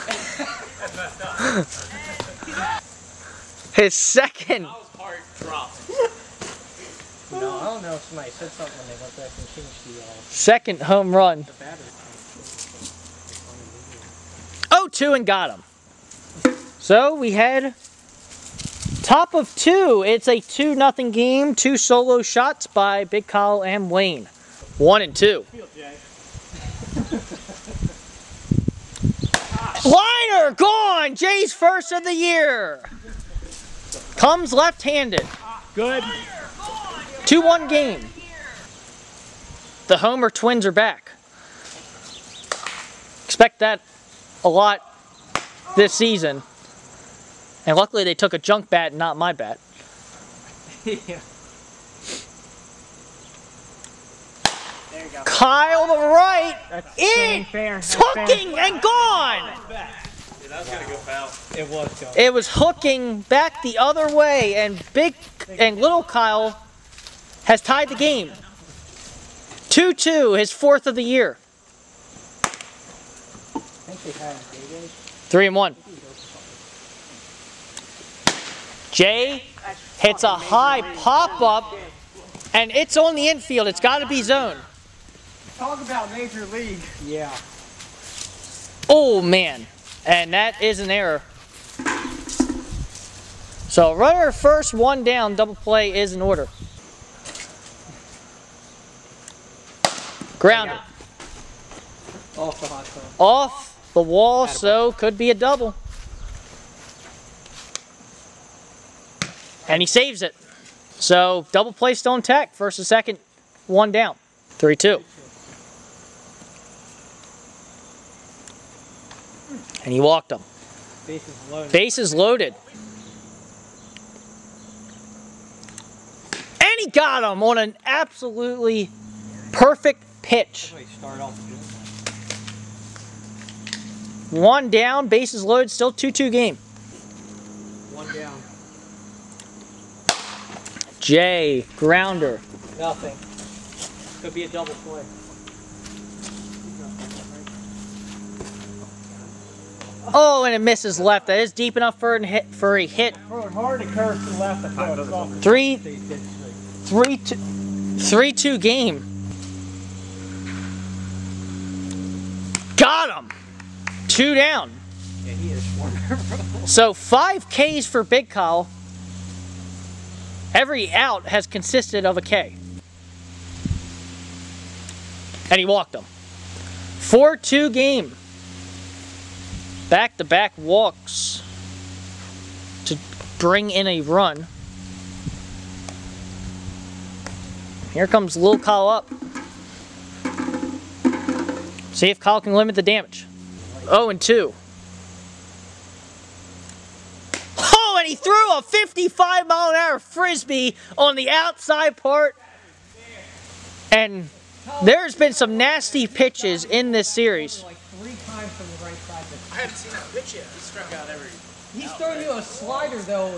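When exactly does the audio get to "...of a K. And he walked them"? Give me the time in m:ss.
2:52.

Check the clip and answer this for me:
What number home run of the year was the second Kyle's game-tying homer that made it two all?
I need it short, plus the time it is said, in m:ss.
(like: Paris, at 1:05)
4th, at 1:10.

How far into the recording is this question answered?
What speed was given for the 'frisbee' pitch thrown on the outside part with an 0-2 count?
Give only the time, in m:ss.
3:18.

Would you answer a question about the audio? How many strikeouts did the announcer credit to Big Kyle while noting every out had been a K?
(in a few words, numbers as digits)
5.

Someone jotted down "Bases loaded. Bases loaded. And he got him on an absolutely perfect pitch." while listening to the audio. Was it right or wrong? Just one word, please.
right.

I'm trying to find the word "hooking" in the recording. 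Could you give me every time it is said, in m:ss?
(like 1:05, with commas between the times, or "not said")
0:57, 1:02.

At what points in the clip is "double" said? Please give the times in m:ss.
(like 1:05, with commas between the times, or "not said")
1:35, 1:45, 1:51, 2:24.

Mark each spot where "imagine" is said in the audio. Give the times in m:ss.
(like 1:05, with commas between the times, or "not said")
not said.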